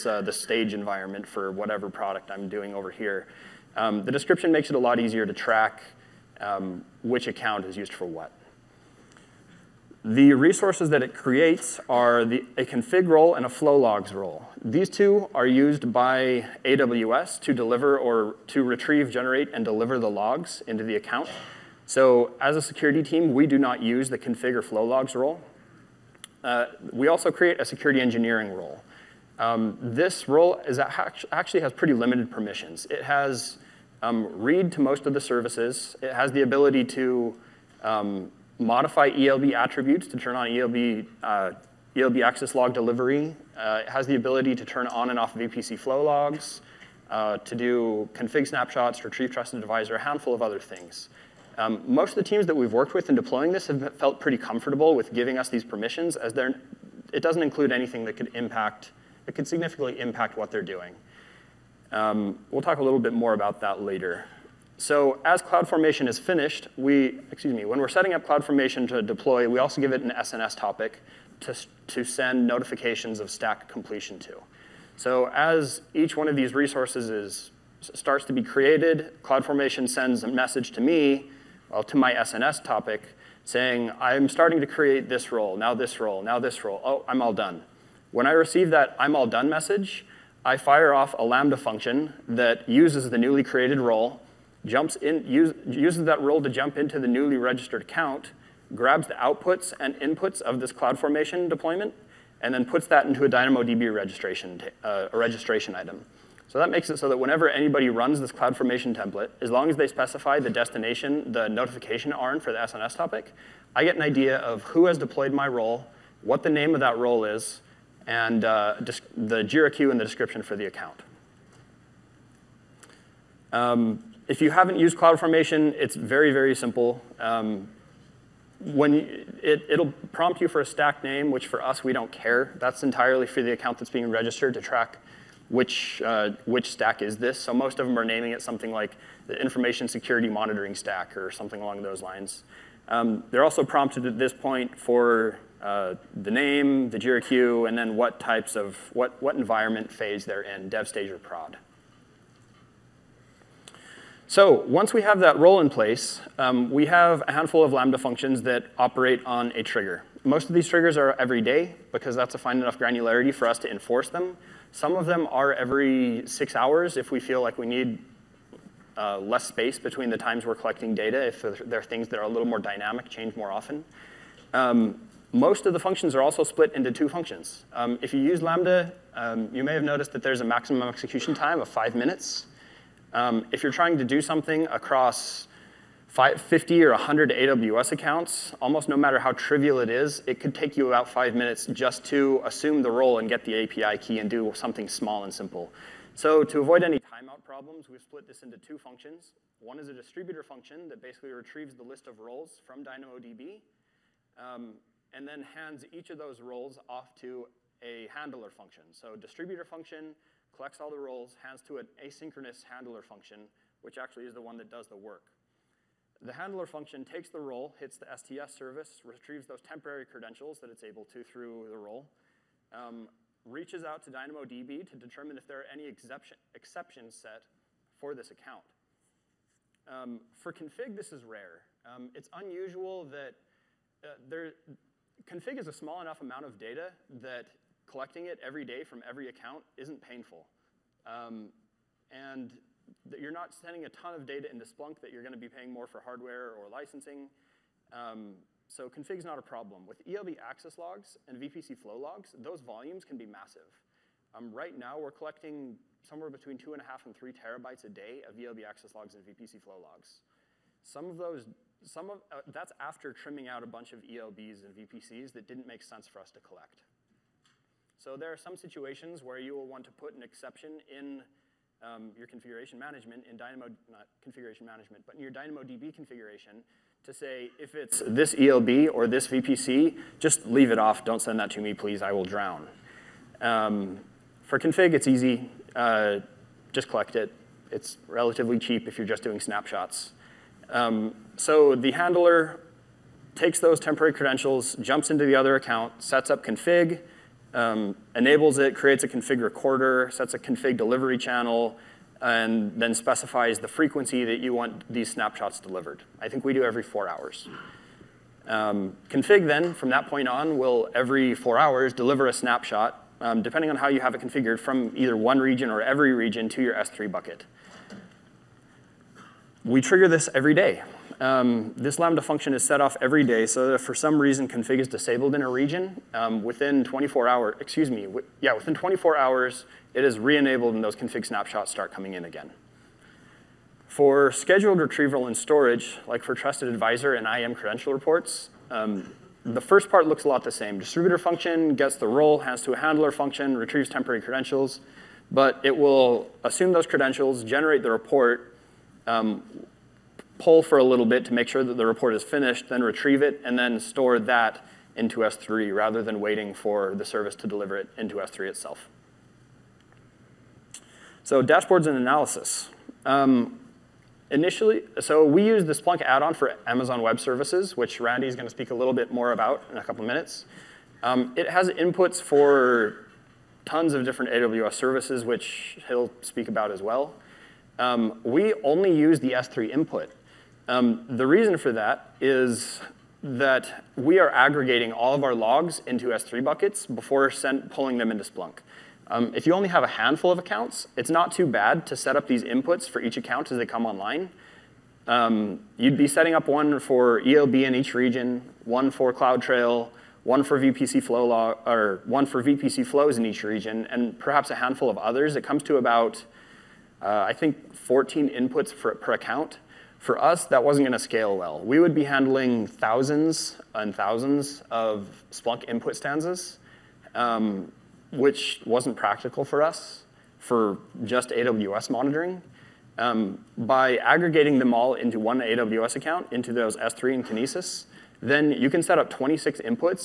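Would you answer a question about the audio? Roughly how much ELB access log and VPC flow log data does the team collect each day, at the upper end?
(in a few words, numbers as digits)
3 terabytes.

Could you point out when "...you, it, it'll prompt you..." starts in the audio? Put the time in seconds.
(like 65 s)
128 s.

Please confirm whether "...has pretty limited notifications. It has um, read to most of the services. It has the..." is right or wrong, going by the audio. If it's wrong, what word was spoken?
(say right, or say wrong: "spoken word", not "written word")
wrong: "permissions", not "notifications".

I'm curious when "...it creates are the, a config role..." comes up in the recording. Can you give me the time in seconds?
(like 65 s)
11 s.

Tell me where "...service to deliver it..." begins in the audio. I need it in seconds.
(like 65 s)
357 s.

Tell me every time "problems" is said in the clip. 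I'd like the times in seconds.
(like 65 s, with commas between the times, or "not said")
197 s, 249 s.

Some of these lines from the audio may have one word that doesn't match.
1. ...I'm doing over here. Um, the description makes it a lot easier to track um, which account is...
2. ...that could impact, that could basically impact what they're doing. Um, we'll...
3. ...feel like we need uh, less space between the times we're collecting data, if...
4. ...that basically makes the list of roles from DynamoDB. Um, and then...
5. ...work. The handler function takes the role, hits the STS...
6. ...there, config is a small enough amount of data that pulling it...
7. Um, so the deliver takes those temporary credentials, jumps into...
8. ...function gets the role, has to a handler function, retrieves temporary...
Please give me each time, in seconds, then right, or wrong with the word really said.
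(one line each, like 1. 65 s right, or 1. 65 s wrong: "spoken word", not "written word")
1. 2 s right
2. 58 s wrong: "significantly", not "basically"
3. 167 s right
4. 200 s wrong: "retrieves", not "makes"
5. 214 s right
6. 234 s wrong: "collecting", not "pulling"
7. 290 s wrong: "handler", not "deliver"
8. 341 s right.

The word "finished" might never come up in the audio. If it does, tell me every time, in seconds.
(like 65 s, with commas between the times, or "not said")
66 s, 352 s.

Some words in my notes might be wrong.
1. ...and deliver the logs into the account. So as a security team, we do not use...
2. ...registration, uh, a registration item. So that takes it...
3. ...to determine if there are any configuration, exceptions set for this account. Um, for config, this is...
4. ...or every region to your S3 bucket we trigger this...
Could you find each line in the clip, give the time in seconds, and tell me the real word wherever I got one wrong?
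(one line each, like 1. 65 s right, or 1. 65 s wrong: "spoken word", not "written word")
1. 19 s right
2. 103 s wrong: "makes", not "takes"
3. 224 s wrong: "exception", not "configuration"
4. 315 s right.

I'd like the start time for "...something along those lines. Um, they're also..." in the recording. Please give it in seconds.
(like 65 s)
141 s.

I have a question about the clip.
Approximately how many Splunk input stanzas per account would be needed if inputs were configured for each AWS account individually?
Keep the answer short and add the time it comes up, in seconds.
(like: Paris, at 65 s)
14, at 407 s.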